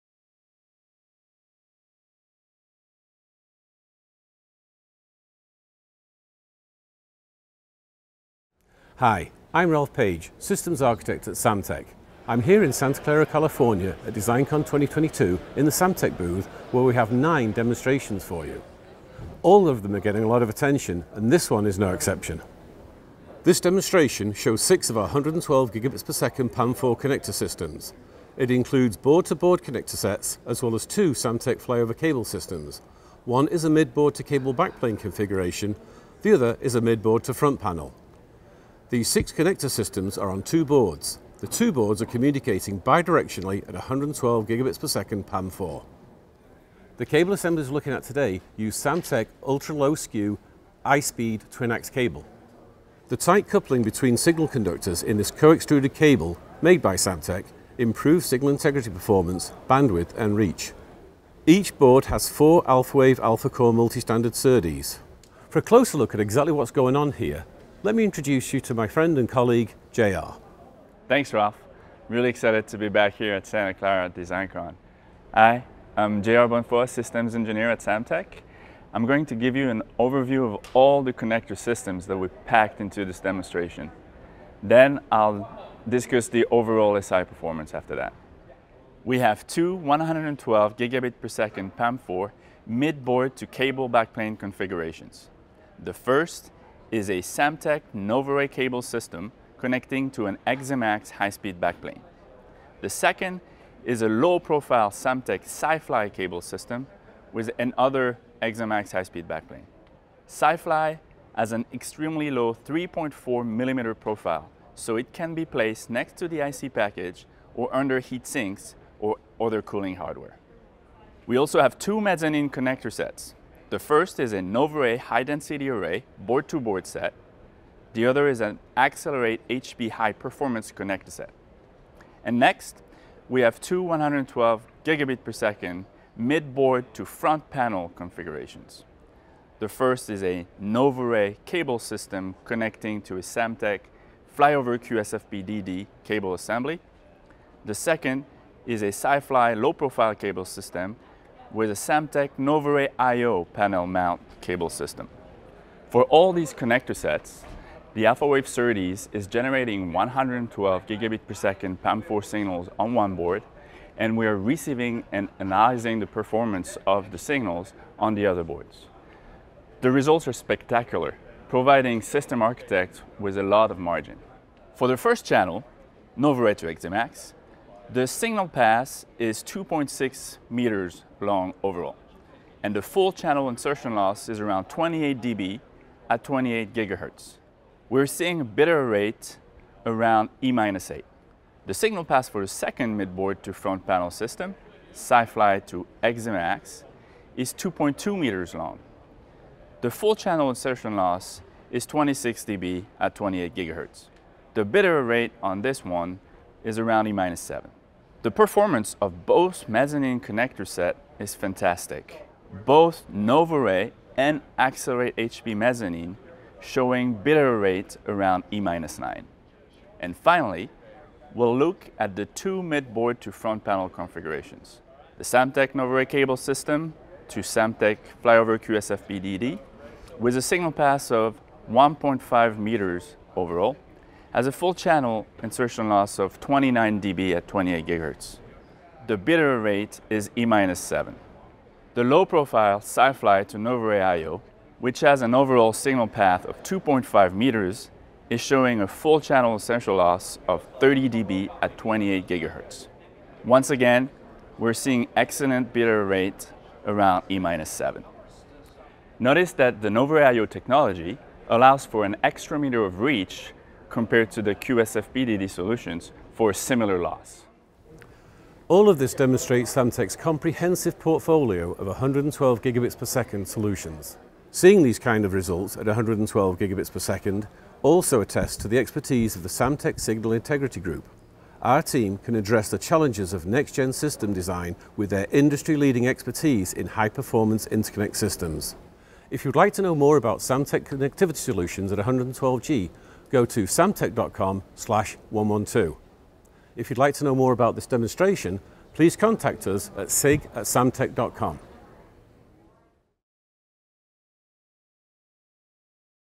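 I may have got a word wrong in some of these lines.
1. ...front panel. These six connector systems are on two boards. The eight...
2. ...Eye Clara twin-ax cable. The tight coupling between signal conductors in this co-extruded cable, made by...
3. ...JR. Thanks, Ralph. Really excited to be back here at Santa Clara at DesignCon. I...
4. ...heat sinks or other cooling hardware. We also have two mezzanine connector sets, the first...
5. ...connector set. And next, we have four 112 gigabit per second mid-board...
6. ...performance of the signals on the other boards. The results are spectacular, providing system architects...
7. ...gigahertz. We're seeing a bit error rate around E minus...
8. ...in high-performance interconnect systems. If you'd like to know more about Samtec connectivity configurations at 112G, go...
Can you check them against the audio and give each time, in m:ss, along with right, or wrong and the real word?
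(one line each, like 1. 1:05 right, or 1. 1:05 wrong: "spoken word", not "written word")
1. 0:37 wrong: "two", not "eight"
2. 0:50 wrong: "Speed", not "Clara"
3. 1:09 right
4. 1:57 right
5. 2:10 wrong: "two", not "four"
6. 2:46 right
7. 3:06 right
8. 4:46 wrong: "solutions", not "configurations".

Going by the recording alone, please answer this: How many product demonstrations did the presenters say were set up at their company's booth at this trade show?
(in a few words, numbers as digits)
9.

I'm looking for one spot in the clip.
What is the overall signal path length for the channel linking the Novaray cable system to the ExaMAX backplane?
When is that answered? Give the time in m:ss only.
2:59.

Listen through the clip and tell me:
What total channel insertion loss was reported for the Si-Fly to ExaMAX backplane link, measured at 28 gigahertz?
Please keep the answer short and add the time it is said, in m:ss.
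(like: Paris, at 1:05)
26 dB, at 3:21.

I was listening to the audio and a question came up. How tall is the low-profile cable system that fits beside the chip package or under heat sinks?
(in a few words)
3.4 millimeters.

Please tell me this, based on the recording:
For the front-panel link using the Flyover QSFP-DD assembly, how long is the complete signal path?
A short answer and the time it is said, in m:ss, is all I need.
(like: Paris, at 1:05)
1.5 meters, at 3:51.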